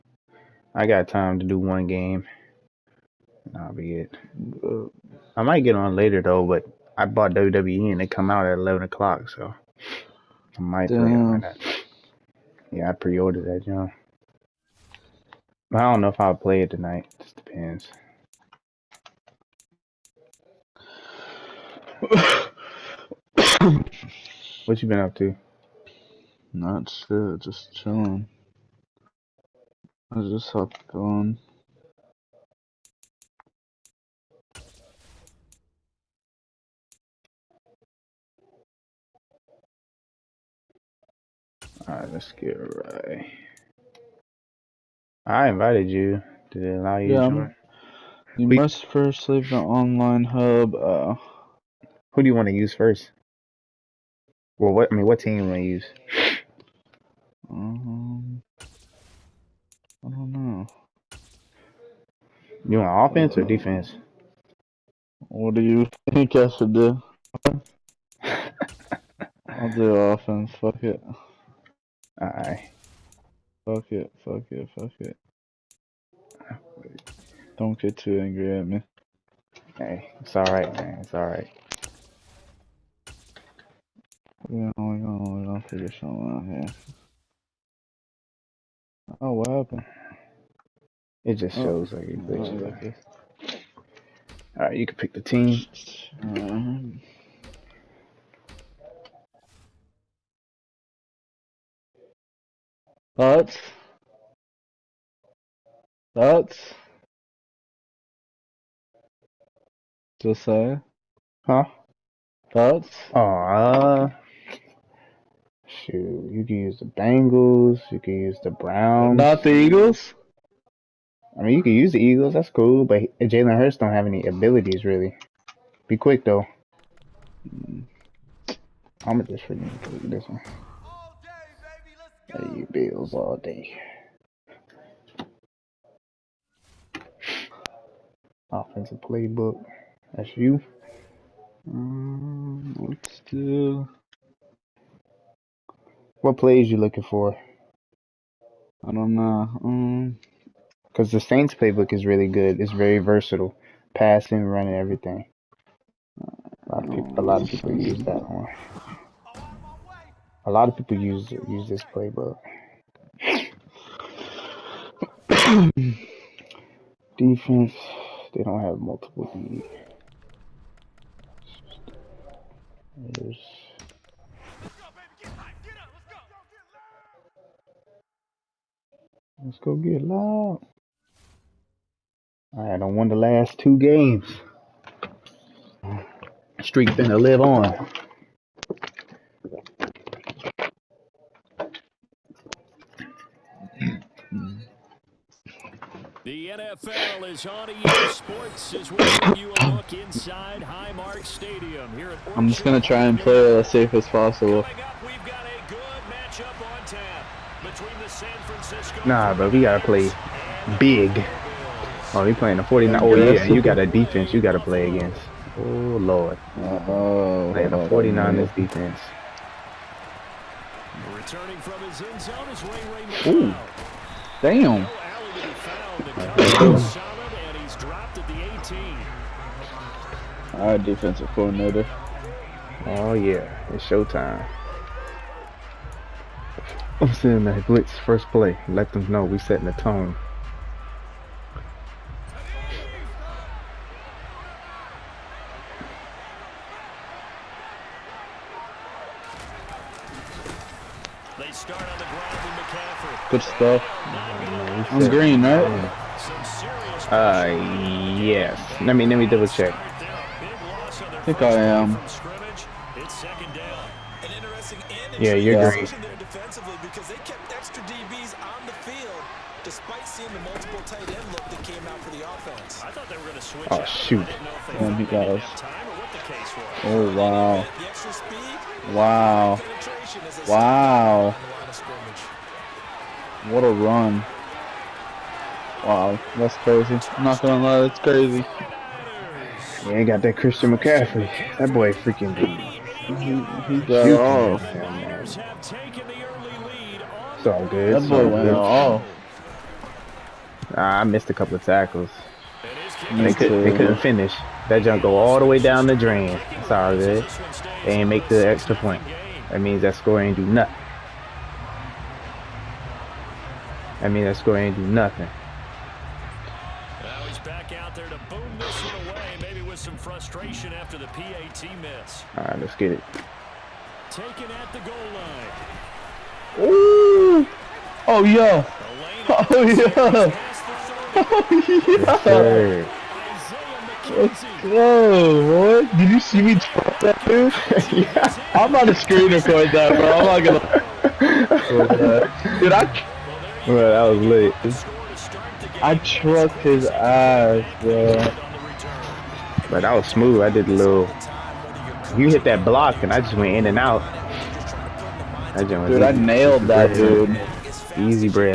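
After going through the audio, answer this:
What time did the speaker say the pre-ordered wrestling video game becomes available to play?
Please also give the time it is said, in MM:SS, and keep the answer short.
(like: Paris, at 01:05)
11 o'clock, at 00:08.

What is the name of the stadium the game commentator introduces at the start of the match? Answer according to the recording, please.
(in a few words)
Highmark Stadium.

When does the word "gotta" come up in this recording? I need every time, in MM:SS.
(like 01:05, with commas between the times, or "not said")
03:29, 03:34.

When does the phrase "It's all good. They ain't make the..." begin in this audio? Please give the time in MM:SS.
05:06.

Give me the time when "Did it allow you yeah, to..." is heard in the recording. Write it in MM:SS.
00:46.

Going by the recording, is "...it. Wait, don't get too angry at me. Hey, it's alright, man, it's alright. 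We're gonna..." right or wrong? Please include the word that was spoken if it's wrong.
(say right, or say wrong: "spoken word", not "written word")
right.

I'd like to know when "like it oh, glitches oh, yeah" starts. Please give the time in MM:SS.
01:31.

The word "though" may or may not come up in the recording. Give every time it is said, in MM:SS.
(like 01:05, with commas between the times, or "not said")
00:06, 02:06.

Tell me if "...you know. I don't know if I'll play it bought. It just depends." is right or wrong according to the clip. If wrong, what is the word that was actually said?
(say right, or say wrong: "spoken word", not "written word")
wrong: "tonight", not "bought".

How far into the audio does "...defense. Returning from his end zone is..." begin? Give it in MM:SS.
03:38.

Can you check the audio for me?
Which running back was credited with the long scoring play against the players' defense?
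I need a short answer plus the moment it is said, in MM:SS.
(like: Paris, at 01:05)
Christian McCaffrey, at 04:50.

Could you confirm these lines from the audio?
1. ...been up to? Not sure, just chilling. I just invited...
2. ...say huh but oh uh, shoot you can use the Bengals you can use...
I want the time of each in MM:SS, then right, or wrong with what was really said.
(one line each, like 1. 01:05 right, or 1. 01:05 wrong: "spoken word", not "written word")
1. 00:24 wrong: "hopped", not "invited"
2. 01:50 right.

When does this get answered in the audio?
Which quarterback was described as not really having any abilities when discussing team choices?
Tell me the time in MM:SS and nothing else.
02:03.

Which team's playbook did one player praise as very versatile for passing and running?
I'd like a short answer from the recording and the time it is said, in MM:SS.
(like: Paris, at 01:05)
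Saints, at 02:31.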